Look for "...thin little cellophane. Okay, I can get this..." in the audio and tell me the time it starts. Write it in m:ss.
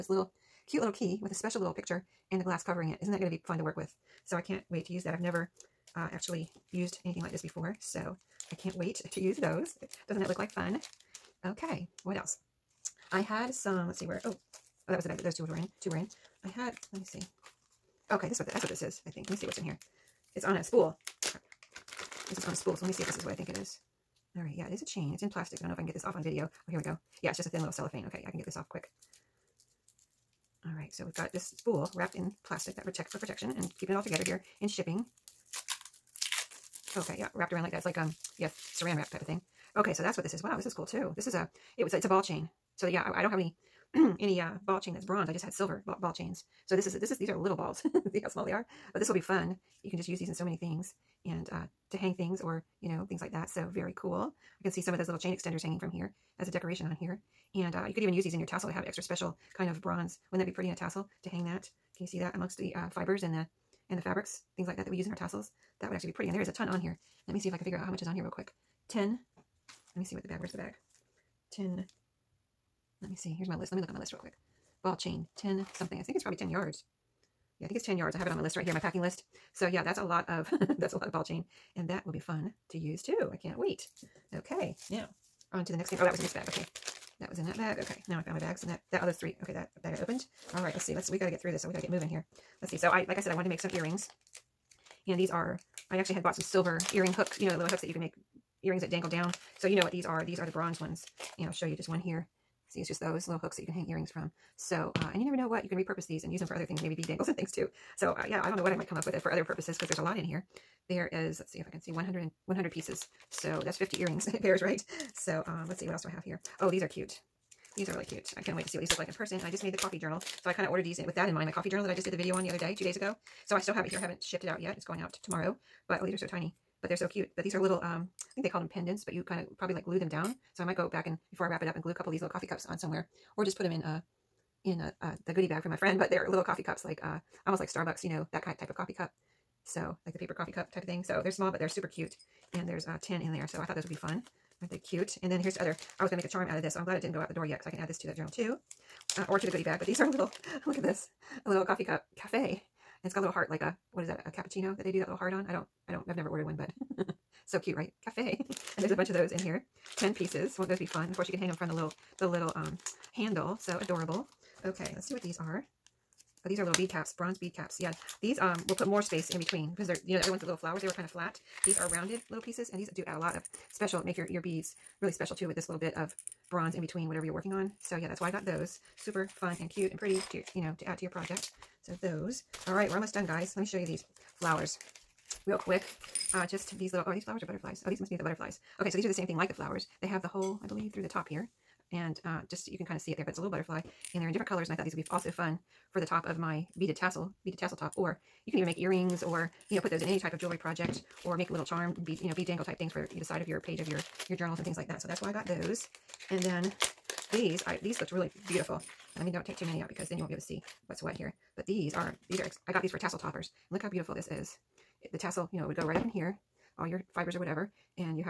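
0:27.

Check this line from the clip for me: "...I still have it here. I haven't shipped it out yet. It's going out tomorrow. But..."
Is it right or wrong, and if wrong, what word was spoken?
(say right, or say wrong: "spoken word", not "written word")
right.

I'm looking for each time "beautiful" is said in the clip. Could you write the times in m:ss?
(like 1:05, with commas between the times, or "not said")
3:28, 3:33.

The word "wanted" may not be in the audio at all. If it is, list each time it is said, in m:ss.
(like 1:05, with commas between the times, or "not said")
1:33.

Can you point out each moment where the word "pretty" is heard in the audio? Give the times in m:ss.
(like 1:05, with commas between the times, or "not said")
1:00, 1:06, 2:59.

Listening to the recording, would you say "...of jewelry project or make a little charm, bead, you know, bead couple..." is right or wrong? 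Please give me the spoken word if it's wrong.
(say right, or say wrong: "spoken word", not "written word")
wrong: "dangle", not "couple".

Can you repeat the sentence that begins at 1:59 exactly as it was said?
And I just made the coffee journal.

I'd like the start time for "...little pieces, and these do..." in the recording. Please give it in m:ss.
2:52.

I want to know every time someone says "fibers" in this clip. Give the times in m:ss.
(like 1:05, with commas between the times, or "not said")
1:02, 3:37.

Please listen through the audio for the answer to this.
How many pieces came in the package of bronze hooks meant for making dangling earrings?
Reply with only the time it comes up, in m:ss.
1:52.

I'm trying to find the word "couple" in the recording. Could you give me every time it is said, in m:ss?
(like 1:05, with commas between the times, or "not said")
2:11.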